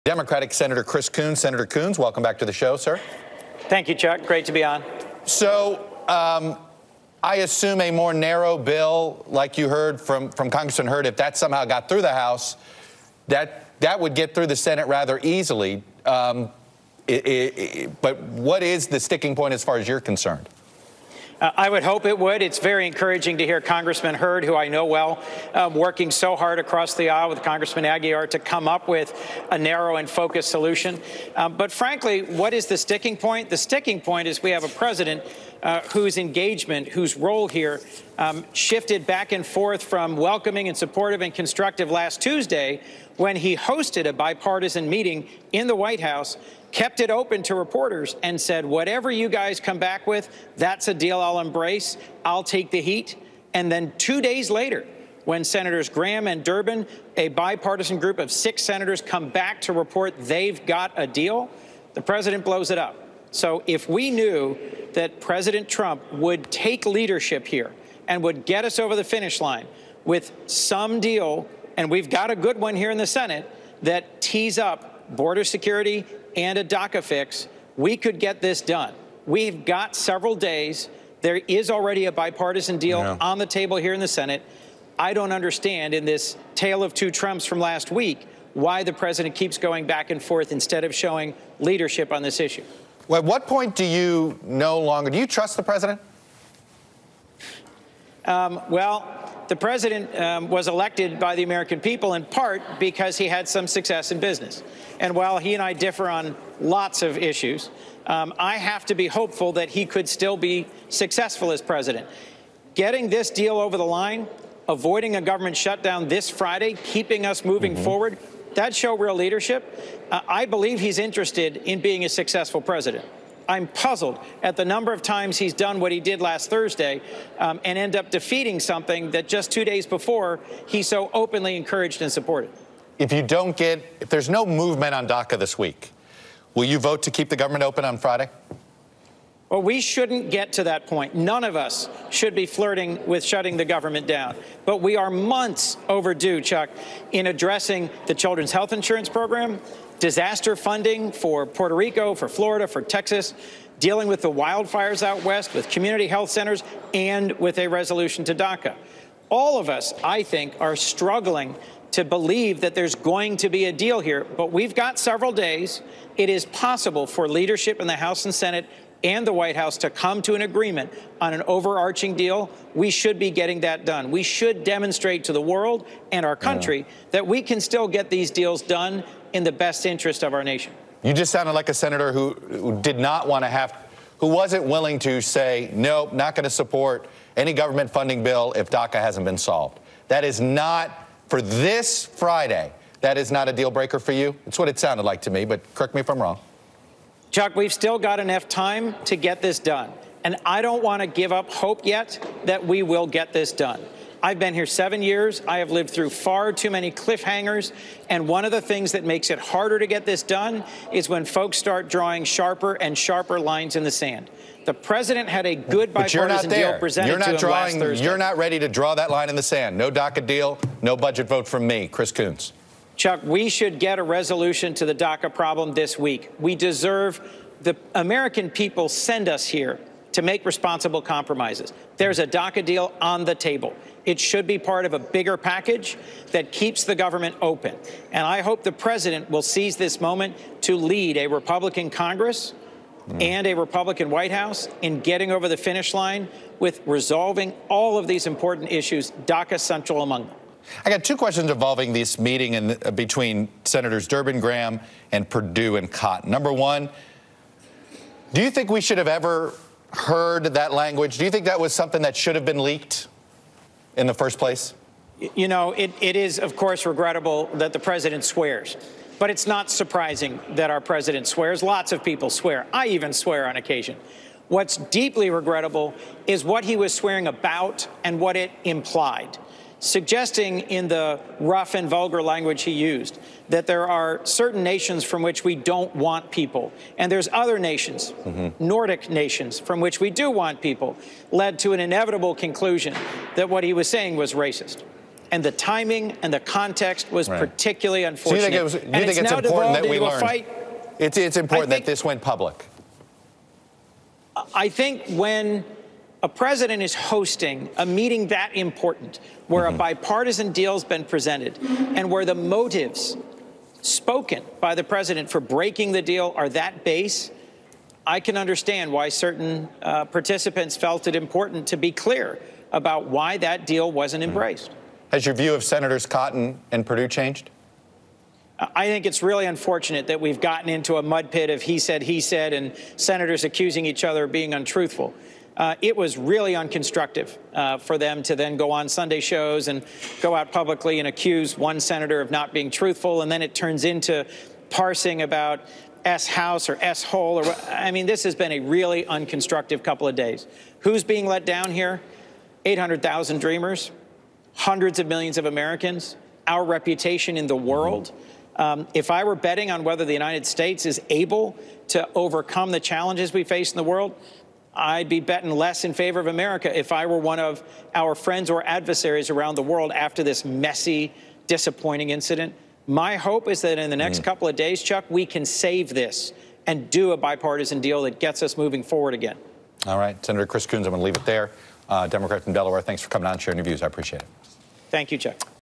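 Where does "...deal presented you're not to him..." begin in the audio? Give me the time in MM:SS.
03:36.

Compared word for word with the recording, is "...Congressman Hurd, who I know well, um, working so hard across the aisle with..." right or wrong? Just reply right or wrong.
right.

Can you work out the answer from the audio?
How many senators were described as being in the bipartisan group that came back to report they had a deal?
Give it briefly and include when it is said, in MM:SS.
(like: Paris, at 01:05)
6, at 00:58.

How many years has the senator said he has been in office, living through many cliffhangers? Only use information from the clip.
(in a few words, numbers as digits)
7.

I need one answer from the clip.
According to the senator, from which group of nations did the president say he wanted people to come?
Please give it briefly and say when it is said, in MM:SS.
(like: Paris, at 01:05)
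Nordic nations, at 04:48.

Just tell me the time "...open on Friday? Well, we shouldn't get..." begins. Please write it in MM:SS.
02:17.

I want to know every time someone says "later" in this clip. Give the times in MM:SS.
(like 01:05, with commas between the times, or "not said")
00:54.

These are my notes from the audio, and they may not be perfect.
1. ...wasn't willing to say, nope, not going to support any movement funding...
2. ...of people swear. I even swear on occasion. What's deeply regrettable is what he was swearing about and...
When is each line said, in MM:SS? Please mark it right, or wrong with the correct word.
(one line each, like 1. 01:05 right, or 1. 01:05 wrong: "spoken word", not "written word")
1. 03:04 wrong: "government", not "movement"
2. 04:31 right.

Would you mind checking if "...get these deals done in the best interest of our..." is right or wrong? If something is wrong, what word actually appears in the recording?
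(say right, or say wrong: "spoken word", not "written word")
right.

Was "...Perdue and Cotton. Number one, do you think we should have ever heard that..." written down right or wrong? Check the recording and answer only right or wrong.
right.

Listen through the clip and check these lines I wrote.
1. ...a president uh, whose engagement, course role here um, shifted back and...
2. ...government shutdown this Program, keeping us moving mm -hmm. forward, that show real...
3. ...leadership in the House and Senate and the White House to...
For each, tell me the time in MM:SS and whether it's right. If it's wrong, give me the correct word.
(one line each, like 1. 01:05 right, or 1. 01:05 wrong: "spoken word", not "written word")
1. 00:34 wrong: "whose", not "course"
2. 01:55 wrong: "Friday", not "Program"
3. 02:47 right.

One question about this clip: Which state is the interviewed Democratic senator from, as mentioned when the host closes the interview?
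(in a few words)
Delaware.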